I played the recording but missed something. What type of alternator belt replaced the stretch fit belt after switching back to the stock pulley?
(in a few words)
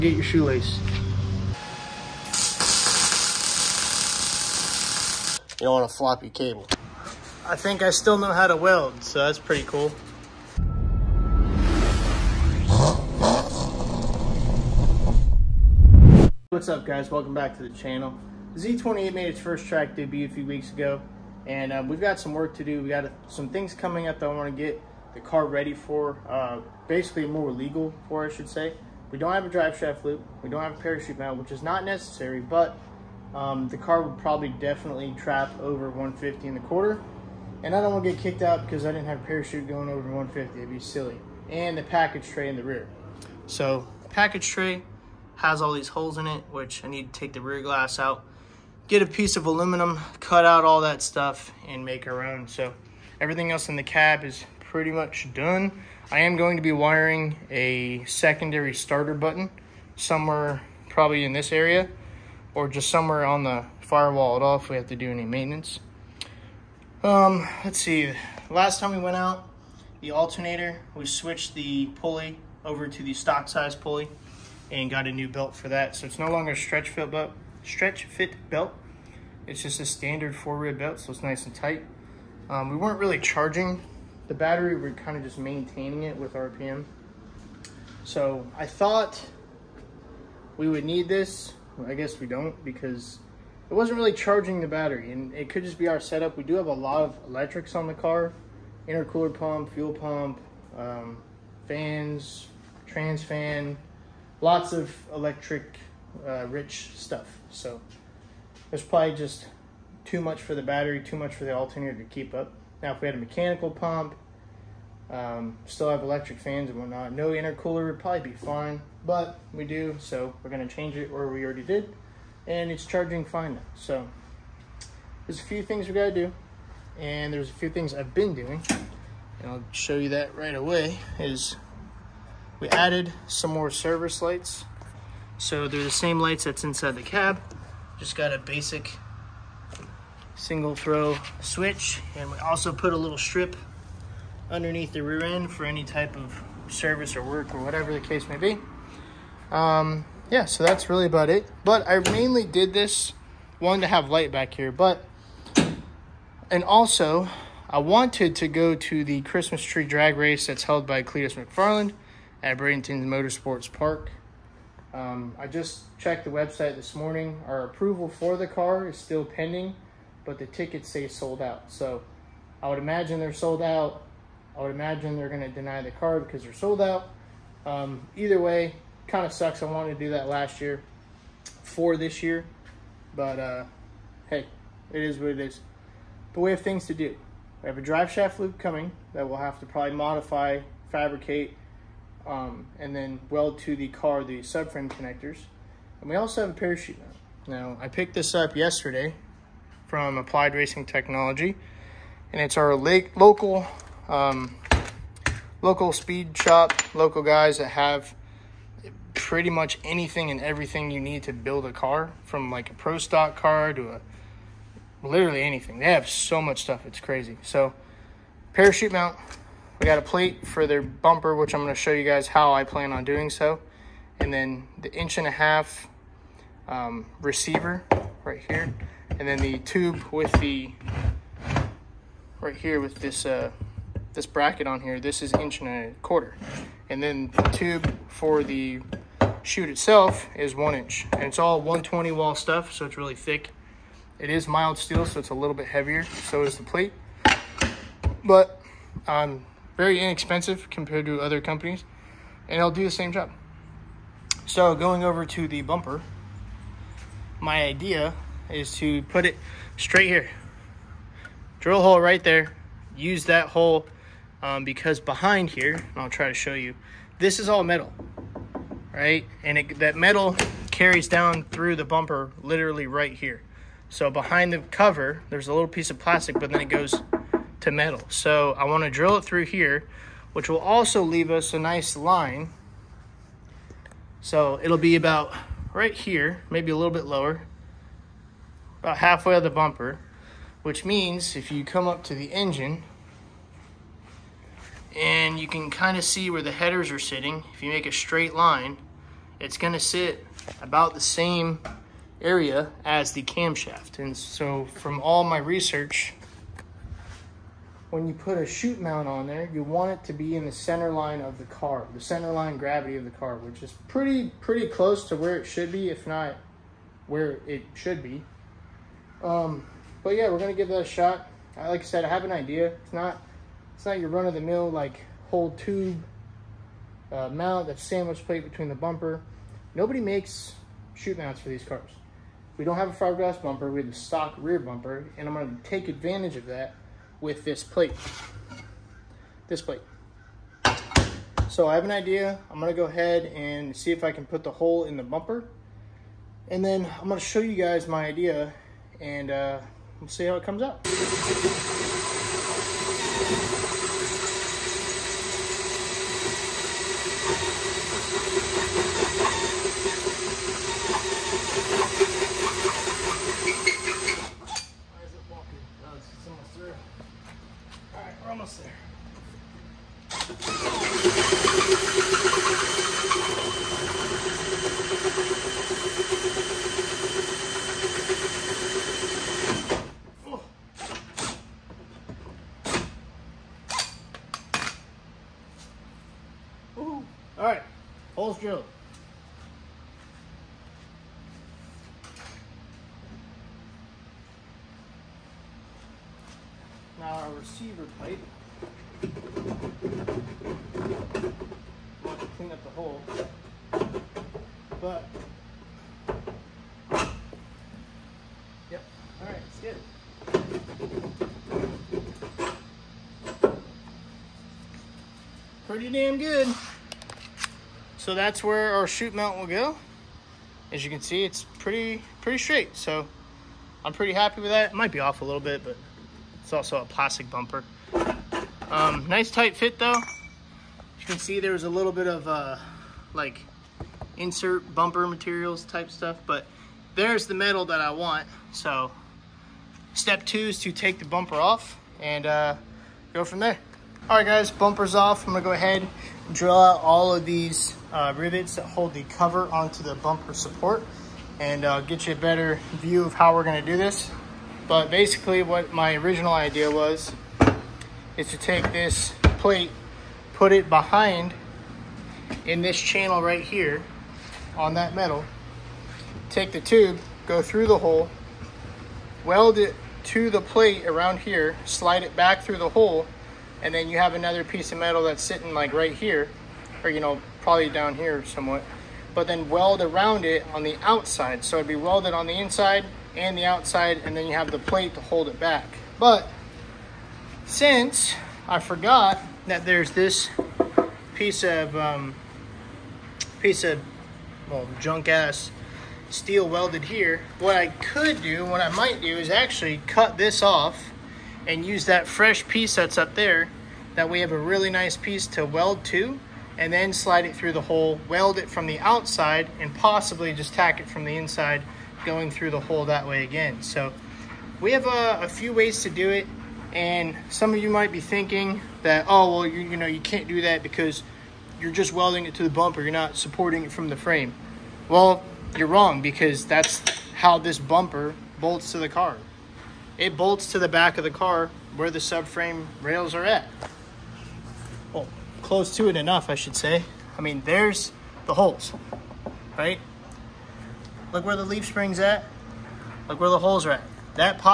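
standard four rib belt.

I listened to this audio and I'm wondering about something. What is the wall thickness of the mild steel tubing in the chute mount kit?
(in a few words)
120 wall.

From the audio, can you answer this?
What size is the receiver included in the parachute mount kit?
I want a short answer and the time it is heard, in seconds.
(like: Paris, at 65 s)
1.5 inch, at 224 s.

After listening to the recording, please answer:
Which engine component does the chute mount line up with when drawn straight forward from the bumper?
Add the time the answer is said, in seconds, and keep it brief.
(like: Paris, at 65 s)
camshaft, at 303 s.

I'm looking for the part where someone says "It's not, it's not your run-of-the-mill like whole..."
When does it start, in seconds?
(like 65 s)
322 s.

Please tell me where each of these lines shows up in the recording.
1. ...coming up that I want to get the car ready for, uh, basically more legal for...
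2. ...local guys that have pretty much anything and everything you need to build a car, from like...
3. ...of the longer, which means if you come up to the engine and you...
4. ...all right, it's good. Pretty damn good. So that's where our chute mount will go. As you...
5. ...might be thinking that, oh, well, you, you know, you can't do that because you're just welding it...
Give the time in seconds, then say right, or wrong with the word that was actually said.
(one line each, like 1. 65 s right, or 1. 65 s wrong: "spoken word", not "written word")
1. 23 s right
2. 206 s right
3. 289 s wrong: "bumper", not "longer"
4. 409 s right
5. 517 s right.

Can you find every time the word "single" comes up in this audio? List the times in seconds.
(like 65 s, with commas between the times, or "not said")
140 s.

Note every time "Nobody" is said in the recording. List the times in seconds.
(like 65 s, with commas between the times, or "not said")
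329 s.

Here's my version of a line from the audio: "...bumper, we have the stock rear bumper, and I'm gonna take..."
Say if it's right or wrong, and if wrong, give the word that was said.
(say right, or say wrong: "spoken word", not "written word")
right.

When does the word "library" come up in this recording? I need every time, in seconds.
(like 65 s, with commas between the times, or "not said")
not said.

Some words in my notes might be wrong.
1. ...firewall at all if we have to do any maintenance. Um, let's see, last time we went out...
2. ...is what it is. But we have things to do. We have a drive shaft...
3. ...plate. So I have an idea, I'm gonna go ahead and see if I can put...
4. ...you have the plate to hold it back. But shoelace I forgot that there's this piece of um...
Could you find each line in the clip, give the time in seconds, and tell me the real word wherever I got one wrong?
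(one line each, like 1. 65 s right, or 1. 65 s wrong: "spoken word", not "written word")
1. 63 s right
2. 185 s right
3. 339 s right
4. 484 s wrong: "since", not "shoelace".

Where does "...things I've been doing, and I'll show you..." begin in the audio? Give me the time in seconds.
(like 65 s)
127 s.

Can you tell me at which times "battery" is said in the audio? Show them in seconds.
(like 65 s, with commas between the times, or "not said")
84 s, 94 s, 110 s.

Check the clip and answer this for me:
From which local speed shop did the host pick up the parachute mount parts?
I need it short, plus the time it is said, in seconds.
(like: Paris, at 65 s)
Applied Racing Technology, at 200 s.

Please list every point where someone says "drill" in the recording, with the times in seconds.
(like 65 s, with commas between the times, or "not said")
261 s, 278 s, 446 s.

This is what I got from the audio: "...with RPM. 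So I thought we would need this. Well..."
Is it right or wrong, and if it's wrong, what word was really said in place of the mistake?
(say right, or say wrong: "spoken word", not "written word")
right.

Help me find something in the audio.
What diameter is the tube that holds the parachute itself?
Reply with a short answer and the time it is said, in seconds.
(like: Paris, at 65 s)
1 inch, at 240 s.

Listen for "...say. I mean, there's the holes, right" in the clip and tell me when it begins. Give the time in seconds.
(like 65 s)
536 s.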